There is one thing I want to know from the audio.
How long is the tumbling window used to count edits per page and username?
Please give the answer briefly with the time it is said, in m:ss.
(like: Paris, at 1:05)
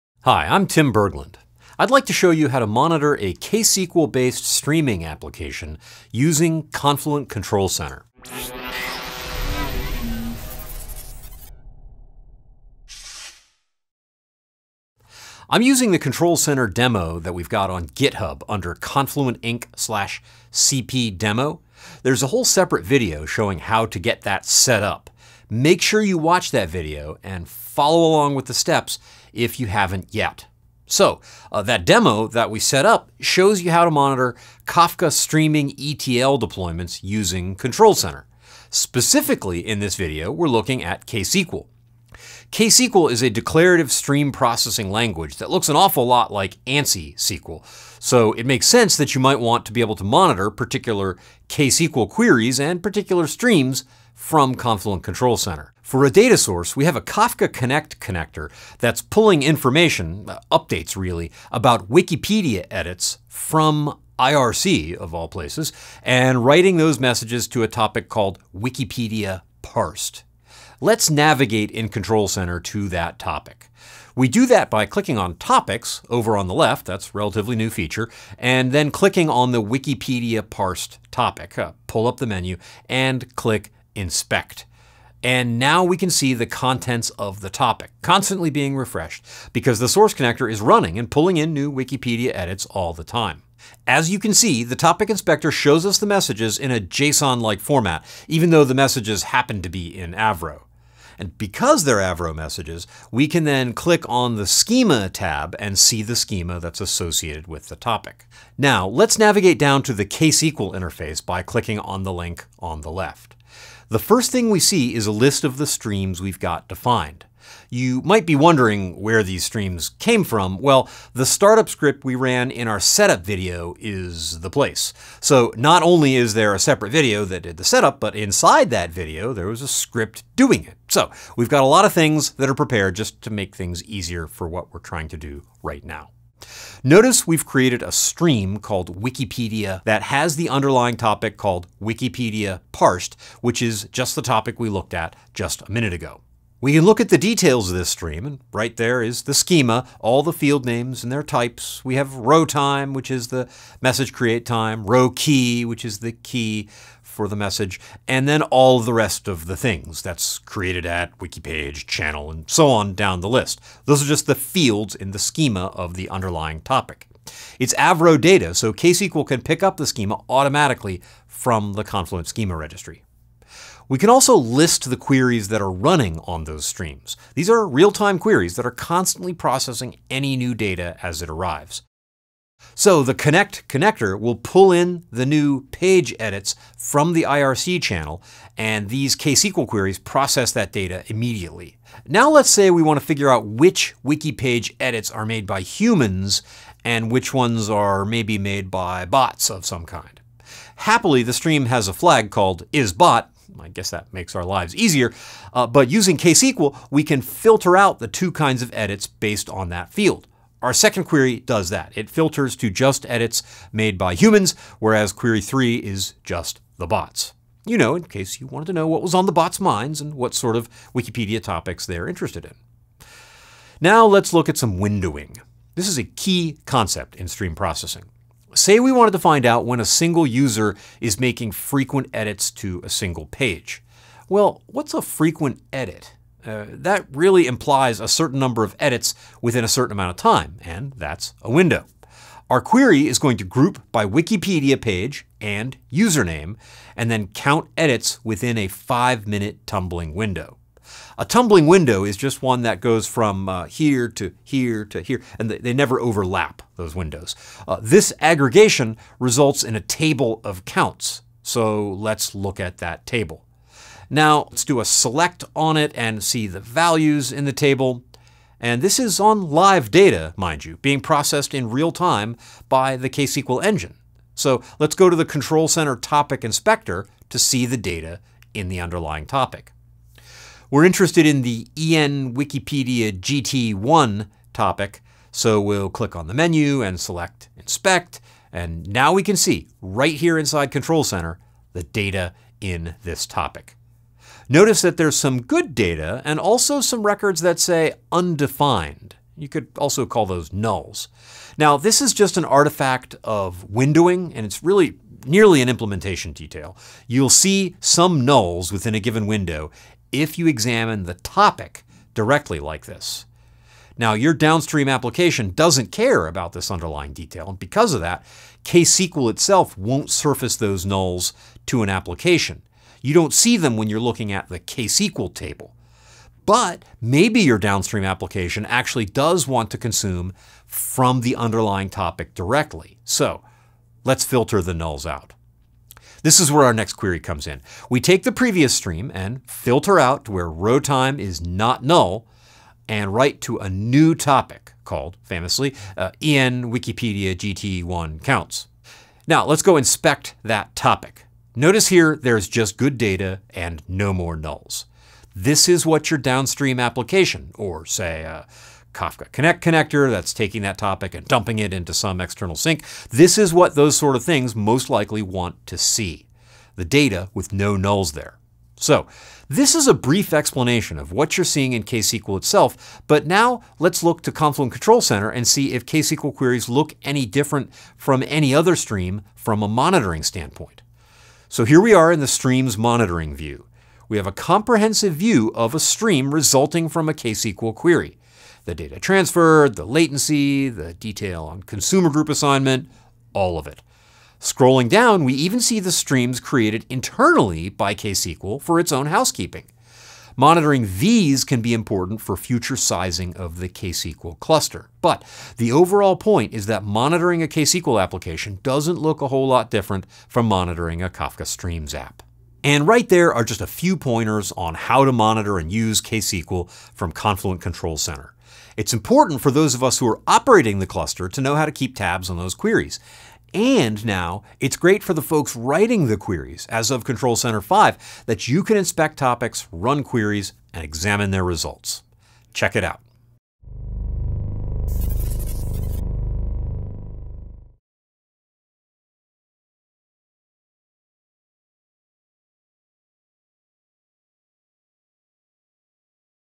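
5 minutes, at 4:08.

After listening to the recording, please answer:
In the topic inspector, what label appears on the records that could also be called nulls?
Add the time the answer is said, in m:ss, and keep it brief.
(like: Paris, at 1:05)
undefined, at 4:58.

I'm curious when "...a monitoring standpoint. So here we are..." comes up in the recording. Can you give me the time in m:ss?
6:19.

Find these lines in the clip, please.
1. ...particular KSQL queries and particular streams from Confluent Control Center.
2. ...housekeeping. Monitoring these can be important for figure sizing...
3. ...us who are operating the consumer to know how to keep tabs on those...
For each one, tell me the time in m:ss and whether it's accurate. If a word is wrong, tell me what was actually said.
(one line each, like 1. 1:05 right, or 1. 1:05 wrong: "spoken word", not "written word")
1. 0:50 right
2. 6:39 wrong: "future", not "figure"
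3. 6:59 wrong: "cluster", not "consumer".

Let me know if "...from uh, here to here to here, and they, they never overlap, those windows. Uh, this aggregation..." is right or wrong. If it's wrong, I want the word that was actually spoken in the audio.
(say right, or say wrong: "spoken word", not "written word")
right.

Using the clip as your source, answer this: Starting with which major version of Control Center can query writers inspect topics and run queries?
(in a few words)
Control Center 5.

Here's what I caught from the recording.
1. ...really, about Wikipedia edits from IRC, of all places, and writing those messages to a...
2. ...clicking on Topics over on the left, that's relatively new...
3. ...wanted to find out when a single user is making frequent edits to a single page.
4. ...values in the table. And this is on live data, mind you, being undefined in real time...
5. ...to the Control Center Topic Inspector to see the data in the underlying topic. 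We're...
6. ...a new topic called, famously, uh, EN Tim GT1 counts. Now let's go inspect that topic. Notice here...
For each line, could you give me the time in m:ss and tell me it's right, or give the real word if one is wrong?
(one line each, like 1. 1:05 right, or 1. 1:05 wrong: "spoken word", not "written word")
1. 1:00 right
2. 1:14 right
3. 3:48 right
4. 4:26 wrong: "processed", not "undefined"
5. 4:35 right
6. 5:43 wrong: "Wikipedia", not "Tim".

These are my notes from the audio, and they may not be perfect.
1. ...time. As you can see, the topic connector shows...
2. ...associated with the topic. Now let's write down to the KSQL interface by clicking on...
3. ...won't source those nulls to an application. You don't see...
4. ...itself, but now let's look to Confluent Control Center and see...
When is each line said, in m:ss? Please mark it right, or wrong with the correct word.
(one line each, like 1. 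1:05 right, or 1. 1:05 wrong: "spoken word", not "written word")
1. 1:33 wrong: "inspector", not "connector"
2. 1:46 wrong: "navigate", not "write"
3. 5:19 wrong: "surface", not "source"
4. 6:12 right.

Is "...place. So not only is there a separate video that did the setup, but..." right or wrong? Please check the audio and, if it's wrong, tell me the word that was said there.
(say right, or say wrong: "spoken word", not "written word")
right.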